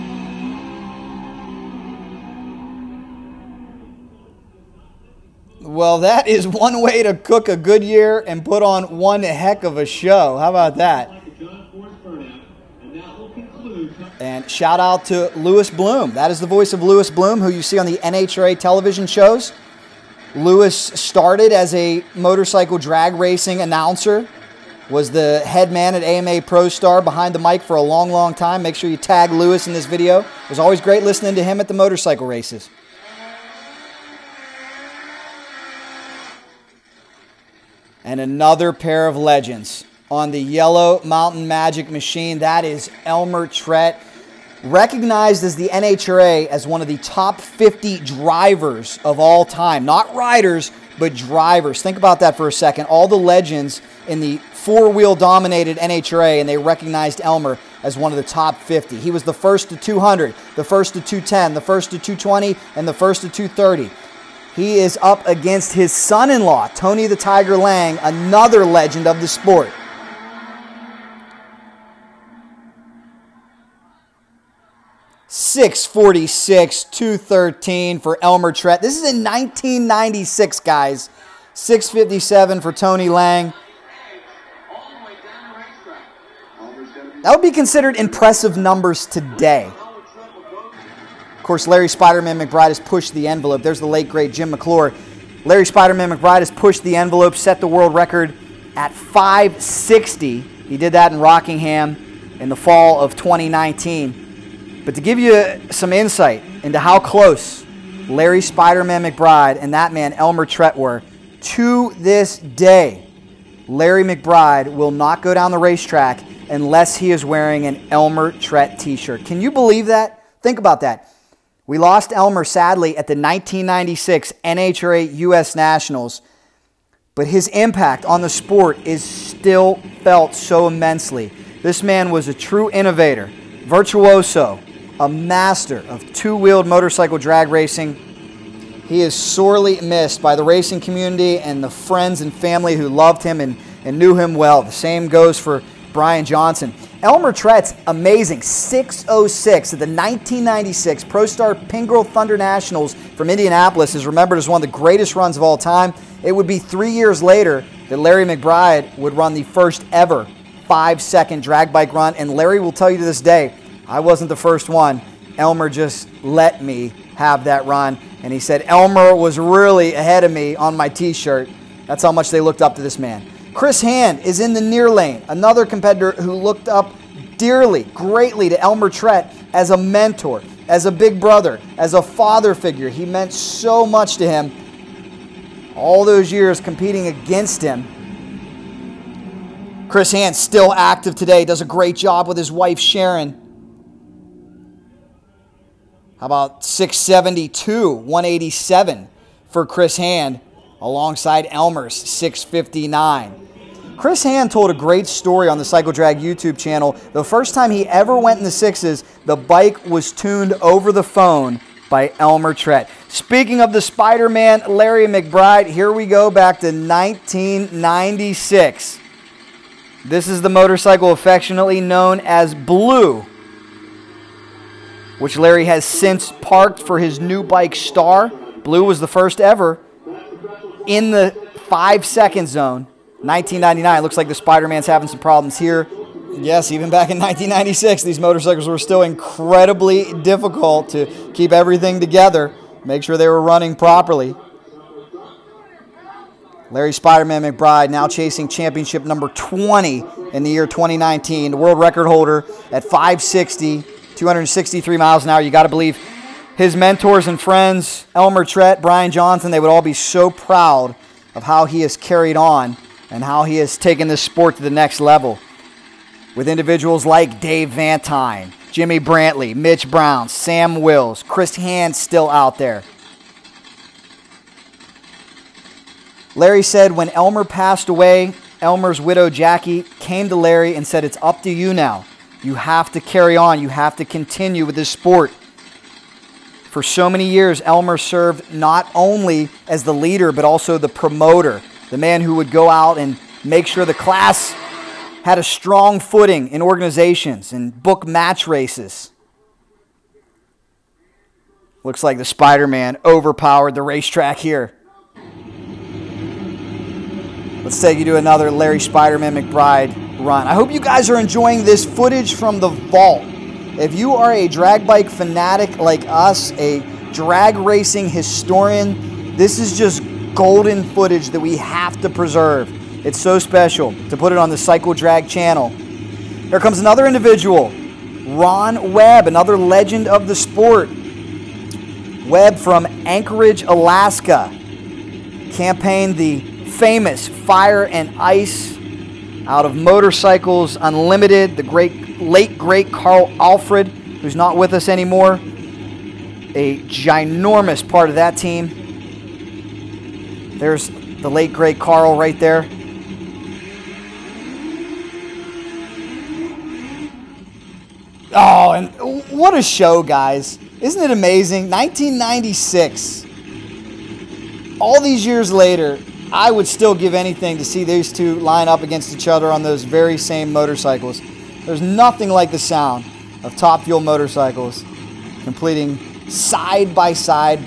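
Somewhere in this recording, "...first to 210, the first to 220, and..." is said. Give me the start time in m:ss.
1:00.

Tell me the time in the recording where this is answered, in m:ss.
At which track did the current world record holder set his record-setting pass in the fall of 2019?
1:41.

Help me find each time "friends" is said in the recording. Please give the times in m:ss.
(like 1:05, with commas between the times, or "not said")
2:21, 4:17.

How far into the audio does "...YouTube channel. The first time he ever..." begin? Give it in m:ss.
3:26.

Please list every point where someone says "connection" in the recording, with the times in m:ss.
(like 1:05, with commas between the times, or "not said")
not said.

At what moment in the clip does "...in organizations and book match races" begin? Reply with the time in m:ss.
4:56.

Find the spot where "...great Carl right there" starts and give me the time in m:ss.
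5:51.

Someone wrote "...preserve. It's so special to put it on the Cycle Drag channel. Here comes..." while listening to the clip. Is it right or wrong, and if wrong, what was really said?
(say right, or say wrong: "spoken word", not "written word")
right.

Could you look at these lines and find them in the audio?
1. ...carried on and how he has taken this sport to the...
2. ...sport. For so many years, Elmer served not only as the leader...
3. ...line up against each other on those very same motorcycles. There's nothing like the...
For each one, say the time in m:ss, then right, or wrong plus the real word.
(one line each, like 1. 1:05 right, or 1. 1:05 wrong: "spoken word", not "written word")
1. 4:21 right
2. 4:44 right
3. 6:08 right.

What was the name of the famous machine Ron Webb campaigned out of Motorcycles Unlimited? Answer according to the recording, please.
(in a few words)
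Fire and Ice.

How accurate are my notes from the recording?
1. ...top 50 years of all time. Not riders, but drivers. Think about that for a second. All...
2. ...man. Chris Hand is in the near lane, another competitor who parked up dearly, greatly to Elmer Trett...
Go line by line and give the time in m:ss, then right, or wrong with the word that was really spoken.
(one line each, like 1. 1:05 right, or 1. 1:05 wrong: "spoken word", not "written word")
1. 0:46 wrong: "drivers", not "years"
2. 2:52 wrong: "looked", not "parked".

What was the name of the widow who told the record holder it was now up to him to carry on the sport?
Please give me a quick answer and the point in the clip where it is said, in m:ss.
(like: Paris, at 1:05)
Jackie, at 4:39.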